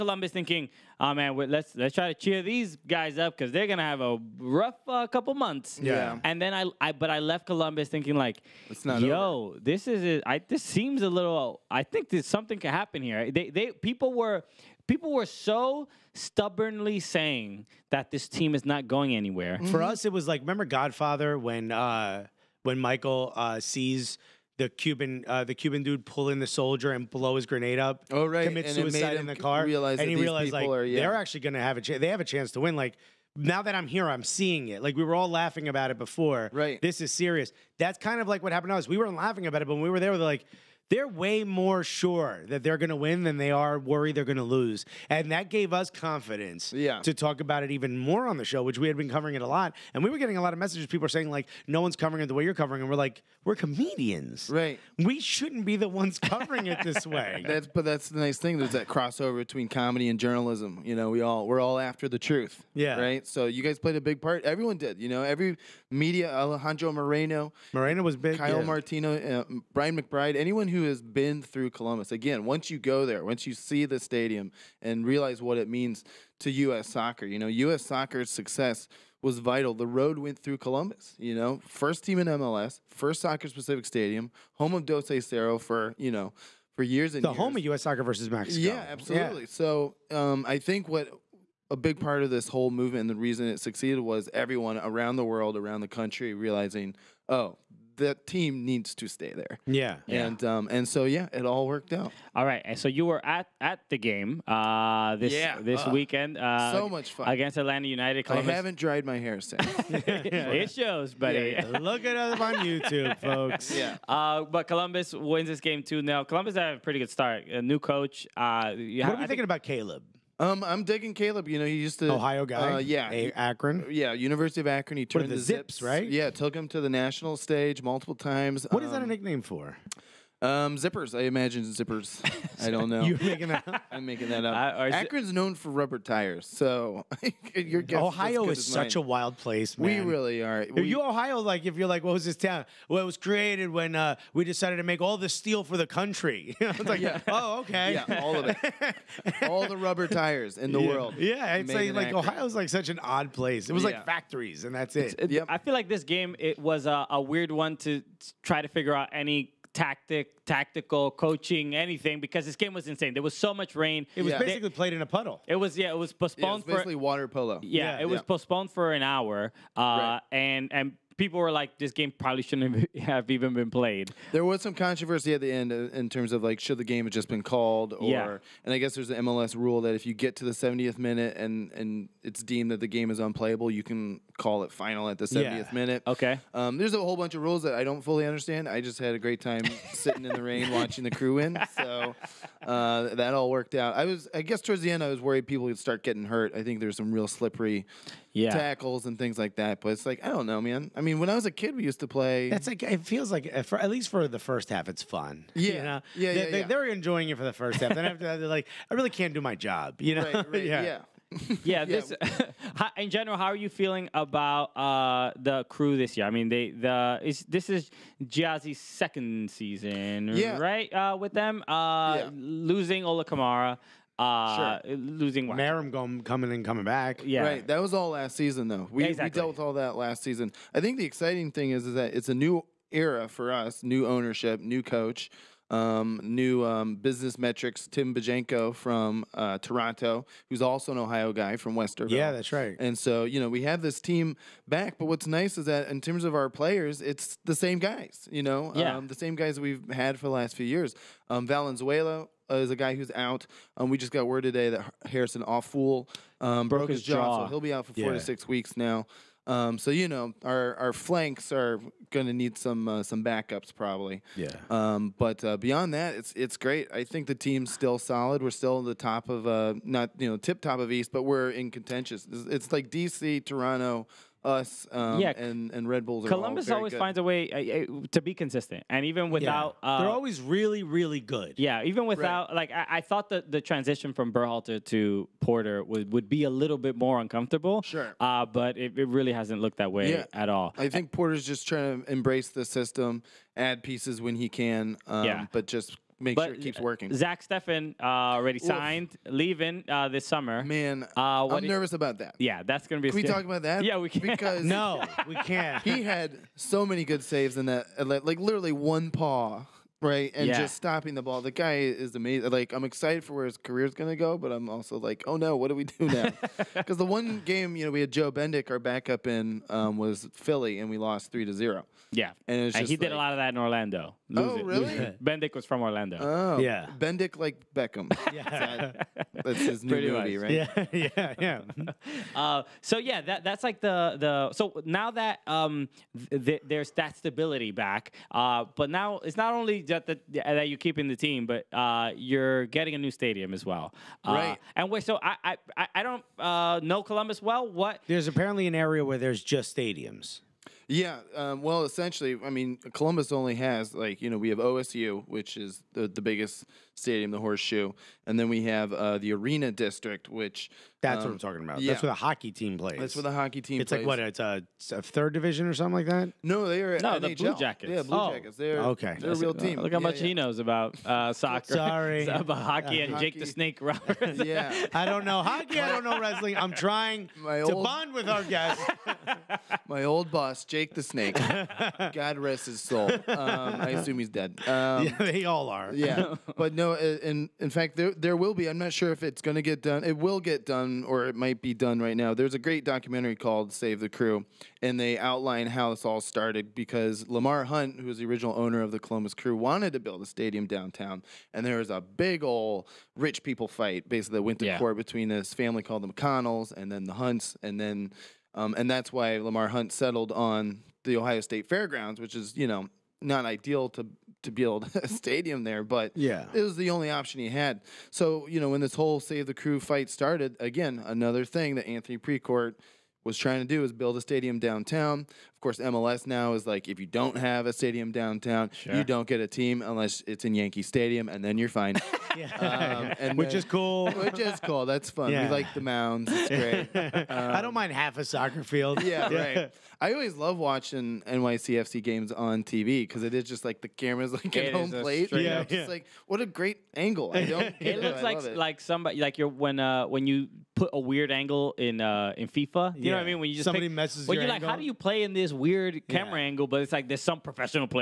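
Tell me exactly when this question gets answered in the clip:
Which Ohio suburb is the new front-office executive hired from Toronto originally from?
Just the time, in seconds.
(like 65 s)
241 s.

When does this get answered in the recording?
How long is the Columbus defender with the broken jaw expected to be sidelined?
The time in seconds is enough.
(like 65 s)
257 s.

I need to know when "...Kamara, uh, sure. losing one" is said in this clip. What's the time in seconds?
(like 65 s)
223 s.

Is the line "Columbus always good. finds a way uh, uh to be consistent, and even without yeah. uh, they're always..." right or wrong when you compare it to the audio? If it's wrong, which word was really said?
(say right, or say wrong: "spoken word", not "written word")
right.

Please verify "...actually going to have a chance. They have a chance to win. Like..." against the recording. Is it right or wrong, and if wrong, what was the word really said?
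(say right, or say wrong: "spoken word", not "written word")
right.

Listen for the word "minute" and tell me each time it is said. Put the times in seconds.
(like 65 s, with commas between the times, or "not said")
180 s, 185 s.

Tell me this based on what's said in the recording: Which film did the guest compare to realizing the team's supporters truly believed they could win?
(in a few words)
Godfather.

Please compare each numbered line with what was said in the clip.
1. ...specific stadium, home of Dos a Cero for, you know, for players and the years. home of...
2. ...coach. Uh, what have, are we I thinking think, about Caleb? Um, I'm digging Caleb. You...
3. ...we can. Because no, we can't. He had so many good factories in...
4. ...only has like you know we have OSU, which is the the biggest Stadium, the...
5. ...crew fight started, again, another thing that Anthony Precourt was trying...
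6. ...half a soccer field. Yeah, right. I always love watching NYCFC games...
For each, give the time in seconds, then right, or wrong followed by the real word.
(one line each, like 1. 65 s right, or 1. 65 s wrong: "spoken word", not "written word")
1. 83 s wrong: "years", not "players"
2. 117 s right
3. 303 s wrong: "saves", not "factories"
4. 353 s right
5. 419 s right
6. 437 s right.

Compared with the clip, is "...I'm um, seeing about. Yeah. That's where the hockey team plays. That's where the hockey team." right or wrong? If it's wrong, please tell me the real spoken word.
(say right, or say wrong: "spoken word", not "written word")
wrong: "talking", not "seeing".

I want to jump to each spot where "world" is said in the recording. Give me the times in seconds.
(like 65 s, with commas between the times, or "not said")
95 s, 150 s.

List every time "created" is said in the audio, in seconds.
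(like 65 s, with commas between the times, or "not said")
143 s.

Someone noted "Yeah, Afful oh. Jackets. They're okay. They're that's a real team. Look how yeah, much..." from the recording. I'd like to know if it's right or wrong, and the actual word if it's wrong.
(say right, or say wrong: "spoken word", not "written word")
wrong: "Blue", not "Afful".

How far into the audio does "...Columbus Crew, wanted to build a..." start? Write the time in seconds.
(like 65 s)
398 s.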